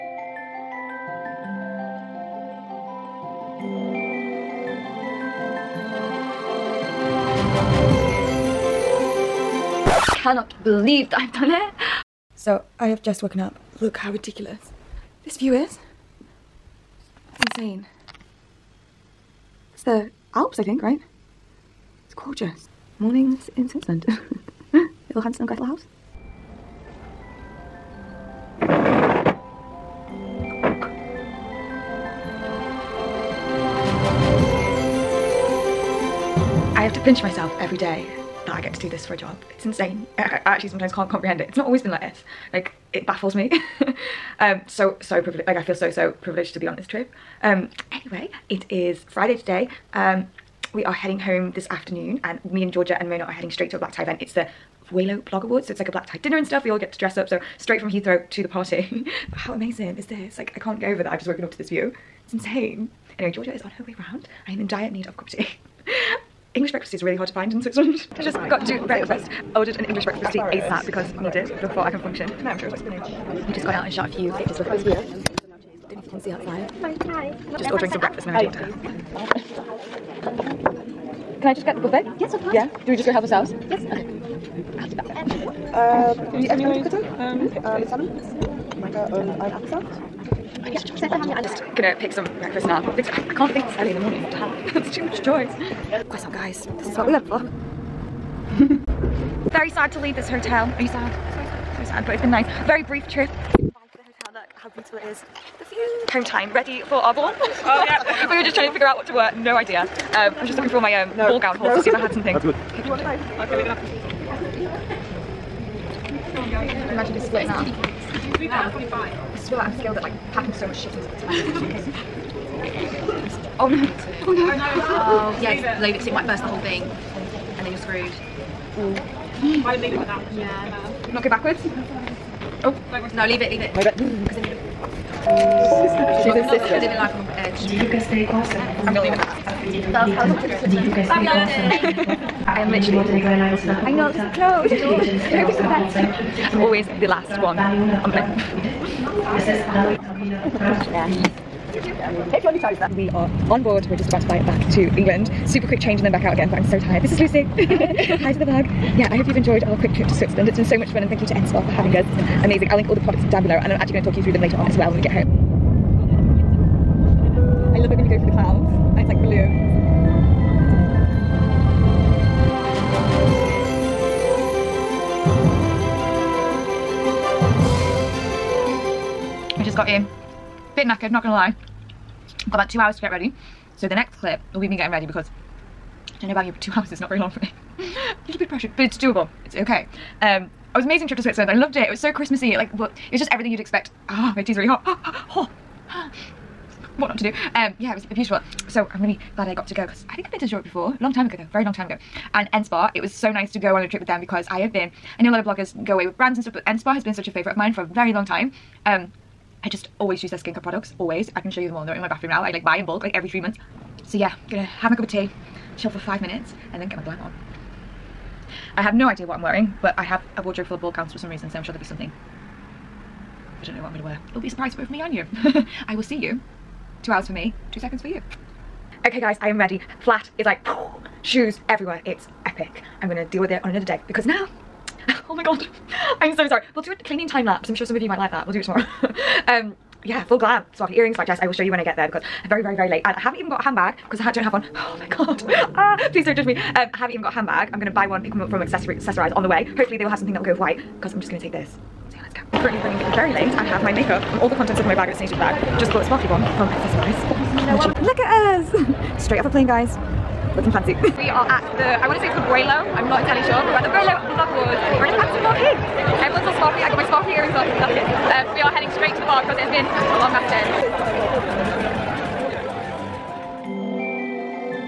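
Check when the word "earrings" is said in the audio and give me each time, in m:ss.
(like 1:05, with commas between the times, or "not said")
4:00, 4:27.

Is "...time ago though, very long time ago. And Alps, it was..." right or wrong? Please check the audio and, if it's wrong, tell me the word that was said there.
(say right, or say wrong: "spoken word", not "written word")
wrong: "NSPA", not "Alps".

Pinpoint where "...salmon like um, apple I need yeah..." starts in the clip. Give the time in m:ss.
1:27.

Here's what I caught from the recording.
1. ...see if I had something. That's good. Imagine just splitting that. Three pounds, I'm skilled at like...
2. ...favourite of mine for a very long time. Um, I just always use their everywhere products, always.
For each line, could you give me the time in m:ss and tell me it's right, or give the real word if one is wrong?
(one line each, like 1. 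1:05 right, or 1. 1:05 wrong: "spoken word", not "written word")
1. 1:51 right
2. 3:27 wrong: "skincare", not "everywhere".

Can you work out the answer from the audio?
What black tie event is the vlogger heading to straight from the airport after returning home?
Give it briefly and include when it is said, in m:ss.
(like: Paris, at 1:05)
Vuelio Blog Awards, at 0:54.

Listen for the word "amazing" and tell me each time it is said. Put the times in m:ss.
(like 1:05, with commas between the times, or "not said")
0:59, 2:42, 3:10.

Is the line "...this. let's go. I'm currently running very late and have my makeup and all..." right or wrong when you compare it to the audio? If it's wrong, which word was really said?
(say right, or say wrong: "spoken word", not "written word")
right.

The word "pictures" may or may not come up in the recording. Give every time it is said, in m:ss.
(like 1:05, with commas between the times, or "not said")
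1:14.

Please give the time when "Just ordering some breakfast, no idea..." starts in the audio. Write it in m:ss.
1:17.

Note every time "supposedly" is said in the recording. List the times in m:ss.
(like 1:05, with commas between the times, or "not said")
not said.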